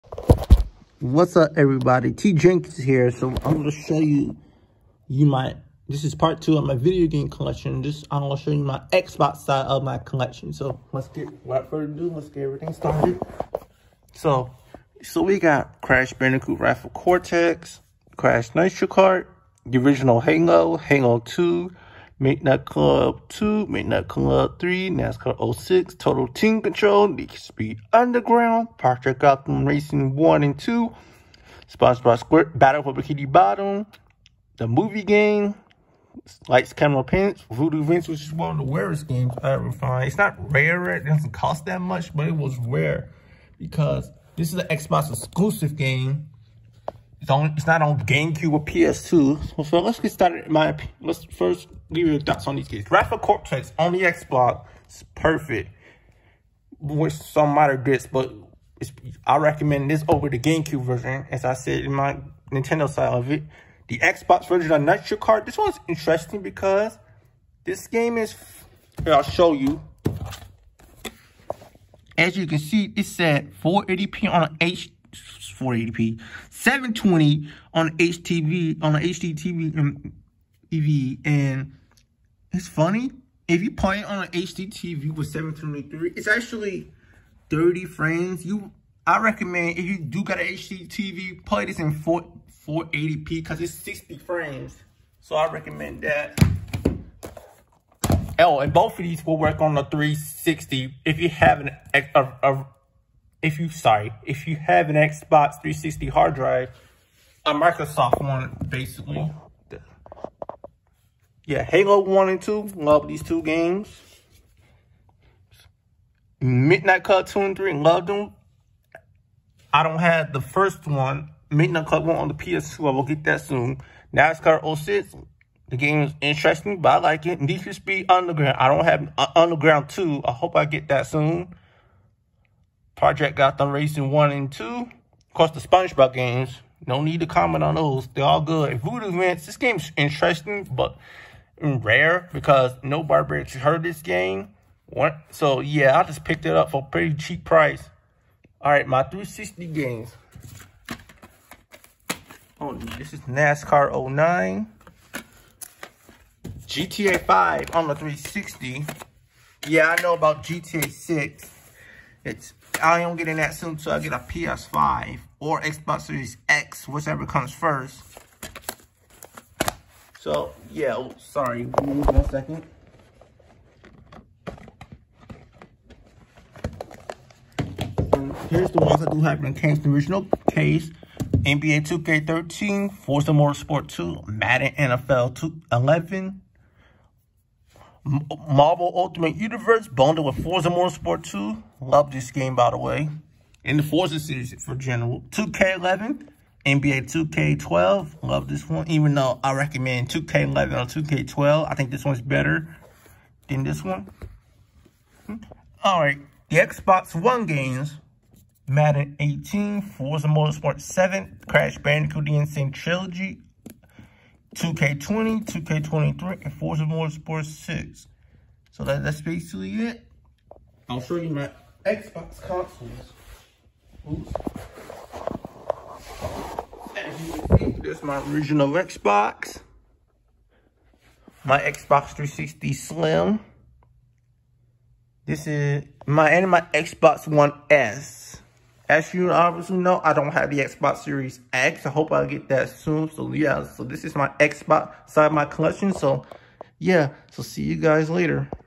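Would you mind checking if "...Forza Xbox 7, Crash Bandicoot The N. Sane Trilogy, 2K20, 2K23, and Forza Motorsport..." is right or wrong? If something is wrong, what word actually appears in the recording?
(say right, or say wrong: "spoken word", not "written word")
wrong: "Motorsport", not "Xbox".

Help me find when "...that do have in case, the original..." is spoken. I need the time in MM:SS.
02:59.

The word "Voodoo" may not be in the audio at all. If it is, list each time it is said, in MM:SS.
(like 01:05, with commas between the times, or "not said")
00:37, 02:18.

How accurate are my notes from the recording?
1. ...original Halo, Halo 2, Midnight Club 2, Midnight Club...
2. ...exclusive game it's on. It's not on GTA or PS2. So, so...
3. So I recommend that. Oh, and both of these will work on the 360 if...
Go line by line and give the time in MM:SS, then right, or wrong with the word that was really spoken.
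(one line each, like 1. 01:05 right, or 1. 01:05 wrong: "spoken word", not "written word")
1. 00:19 right
2. 00:45 wrong: "GameCube", not "GTA"
3. 01:35 right.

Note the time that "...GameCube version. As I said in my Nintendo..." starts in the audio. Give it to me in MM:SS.
01:00.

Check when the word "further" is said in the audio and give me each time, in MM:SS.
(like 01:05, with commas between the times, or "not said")
00:11.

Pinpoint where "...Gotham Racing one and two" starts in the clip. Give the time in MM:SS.
02:13.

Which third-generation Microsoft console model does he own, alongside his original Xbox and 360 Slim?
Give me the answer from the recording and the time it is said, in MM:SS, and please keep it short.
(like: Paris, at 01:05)
Xbox One S, at 03:56.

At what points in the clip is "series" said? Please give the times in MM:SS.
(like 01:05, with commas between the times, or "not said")
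02:46, 03:14, 04:00.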